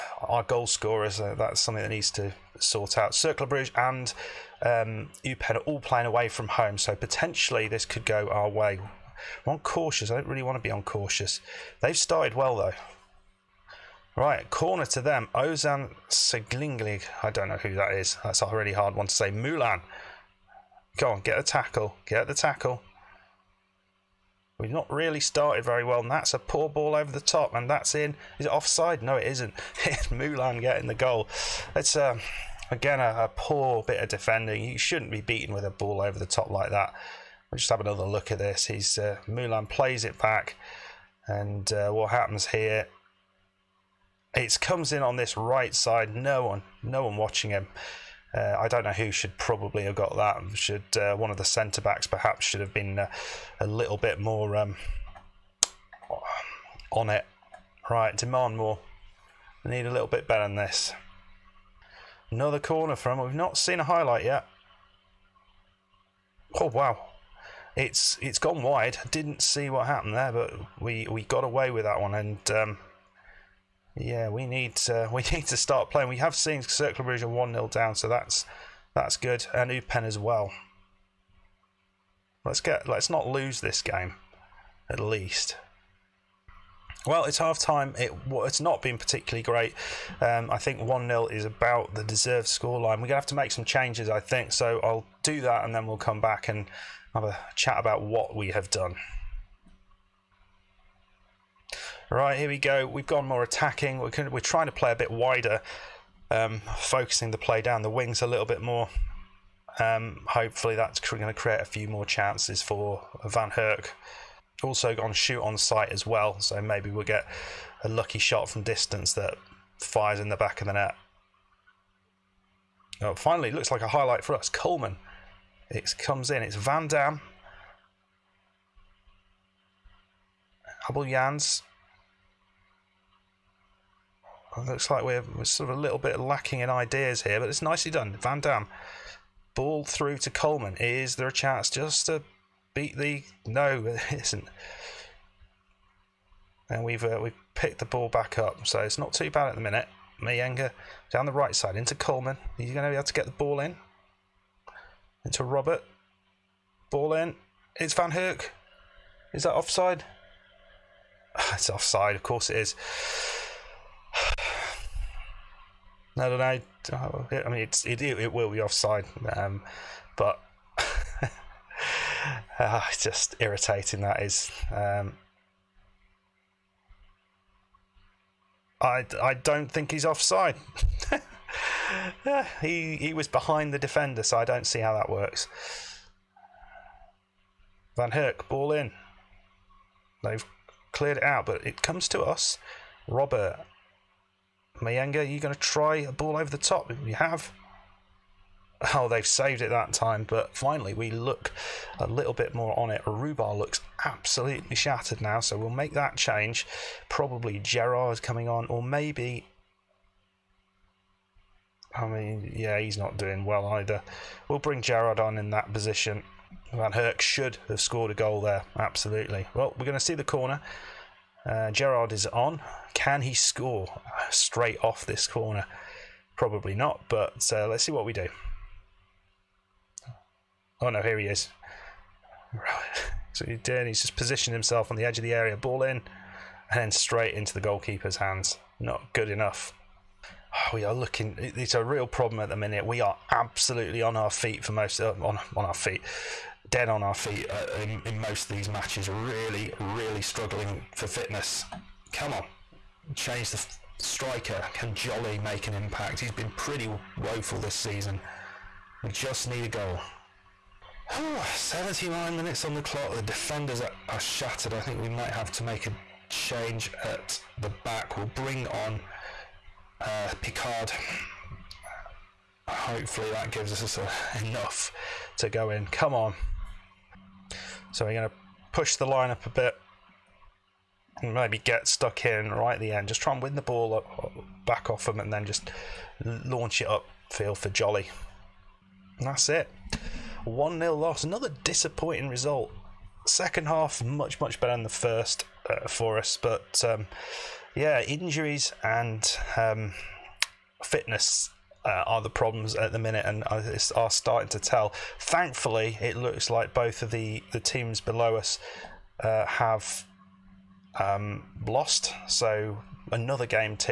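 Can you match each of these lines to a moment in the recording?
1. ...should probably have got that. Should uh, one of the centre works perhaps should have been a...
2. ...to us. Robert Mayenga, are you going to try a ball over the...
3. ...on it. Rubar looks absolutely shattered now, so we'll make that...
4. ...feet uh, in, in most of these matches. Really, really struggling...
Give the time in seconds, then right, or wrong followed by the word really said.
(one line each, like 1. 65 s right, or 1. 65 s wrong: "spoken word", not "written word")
1. 49 s wrong: "backs", not "works"
2. 192 s right
3. 202 s right
4. 247 s right.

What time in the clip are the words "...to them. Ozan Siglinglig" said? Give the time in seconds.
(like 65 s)
14 s.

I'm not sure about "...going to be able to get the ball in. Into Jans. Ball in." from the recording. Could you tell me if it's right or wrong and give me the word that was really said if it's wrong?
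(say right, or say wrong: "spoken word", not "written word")
wrong: "Robert", not "Jans".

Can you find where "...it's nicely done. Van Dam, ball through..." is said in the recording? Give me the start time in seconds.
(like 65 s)
137 s.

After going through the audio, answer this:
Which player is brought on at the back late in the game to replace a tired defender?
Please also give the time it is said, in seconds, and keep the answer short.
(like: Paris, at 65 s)
Picard, at 270 s.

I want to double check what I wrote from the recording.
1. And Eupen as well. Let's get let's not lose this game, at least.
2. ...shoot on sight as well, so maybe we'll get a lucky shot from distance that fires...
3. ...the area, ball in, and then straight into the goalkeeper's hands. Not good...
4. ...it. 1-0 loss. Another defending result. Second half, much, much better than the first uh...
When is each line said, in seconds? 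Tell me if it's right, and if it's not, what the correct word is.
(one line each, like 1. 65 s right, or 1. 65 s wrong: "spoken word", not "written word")
1. 79 s right
2. 115 s right
3. 235 s right
4. 289 s wrong: "disappointing", not "defending".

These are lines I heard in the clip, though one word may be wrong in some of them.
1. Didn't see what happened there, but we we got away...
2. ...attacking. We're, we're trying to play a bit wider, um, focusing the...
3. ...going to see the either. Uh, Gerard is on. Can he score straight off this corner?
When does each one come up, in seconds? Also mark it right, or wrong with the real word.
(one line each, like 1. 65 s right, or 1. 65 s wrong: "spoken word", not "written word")
1. 69 s right
2. 103 s right
3. 219 s wrong: "corner", not "either".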